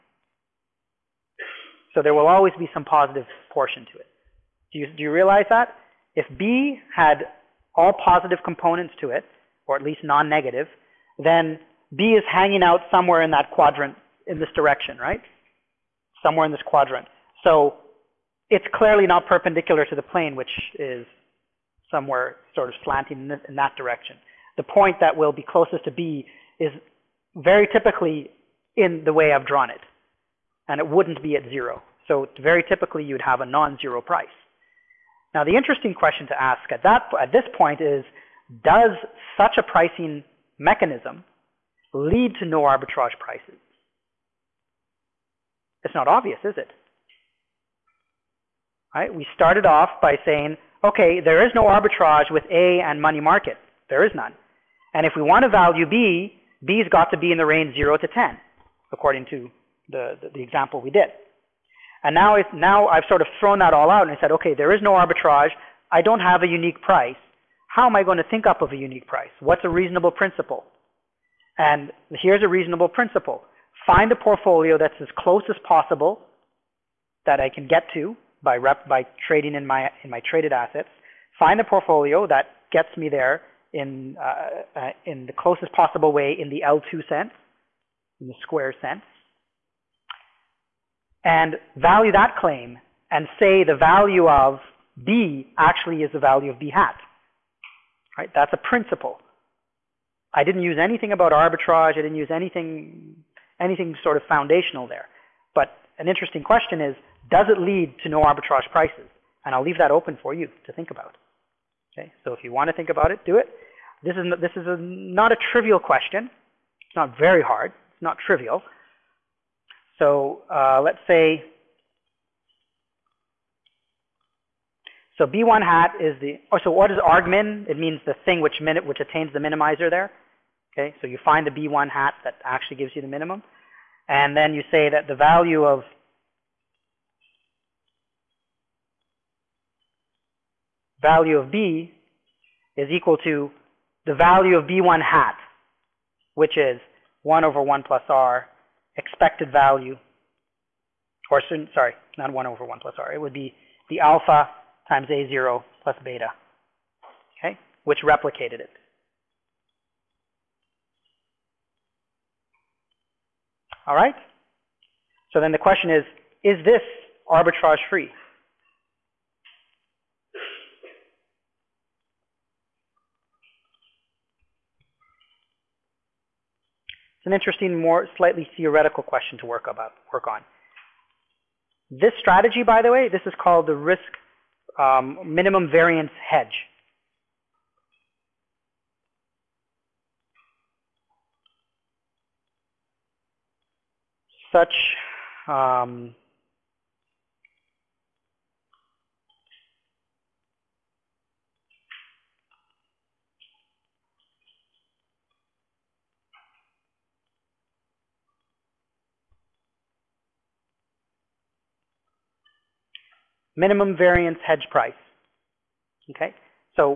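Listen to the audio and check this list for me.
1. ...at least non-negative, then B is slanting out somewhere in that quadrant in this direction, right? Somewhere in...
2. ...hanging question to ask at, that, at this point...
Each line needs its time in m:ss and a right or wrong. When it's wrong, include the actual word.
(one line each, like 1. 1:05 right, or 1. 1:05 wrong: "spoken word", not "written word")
1. 0:09 wrong: "hanging", not "slanting"
2. 0:35 wrong: "interesting", not "hanging".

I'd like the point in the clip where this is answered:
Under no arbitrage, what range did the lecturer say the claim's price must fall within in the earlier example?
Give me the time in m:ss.
0:57.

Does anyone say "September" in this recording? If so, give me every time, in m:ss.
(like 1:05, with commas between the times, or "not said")
not said.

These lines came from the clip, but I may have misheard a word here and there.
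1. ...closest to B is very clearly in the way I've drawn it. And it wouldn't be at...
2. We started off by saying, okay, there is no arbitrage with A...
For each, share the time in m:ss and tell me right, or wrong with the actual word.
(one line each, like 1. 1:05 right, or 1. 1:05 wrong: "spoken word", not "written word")
1. 0:25 wrong: "typically", not "clearly"
2. 0:49 right.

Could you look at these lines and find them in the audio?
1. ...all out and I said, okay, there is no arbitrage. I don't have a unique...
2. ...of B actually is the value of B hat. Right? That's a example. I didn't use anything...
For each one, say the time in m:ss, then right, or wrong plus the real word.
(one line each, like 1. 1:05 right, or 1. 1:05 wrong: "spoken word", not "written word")
1. 1:03 right
2. 1:34 wrong: "principle", not "example".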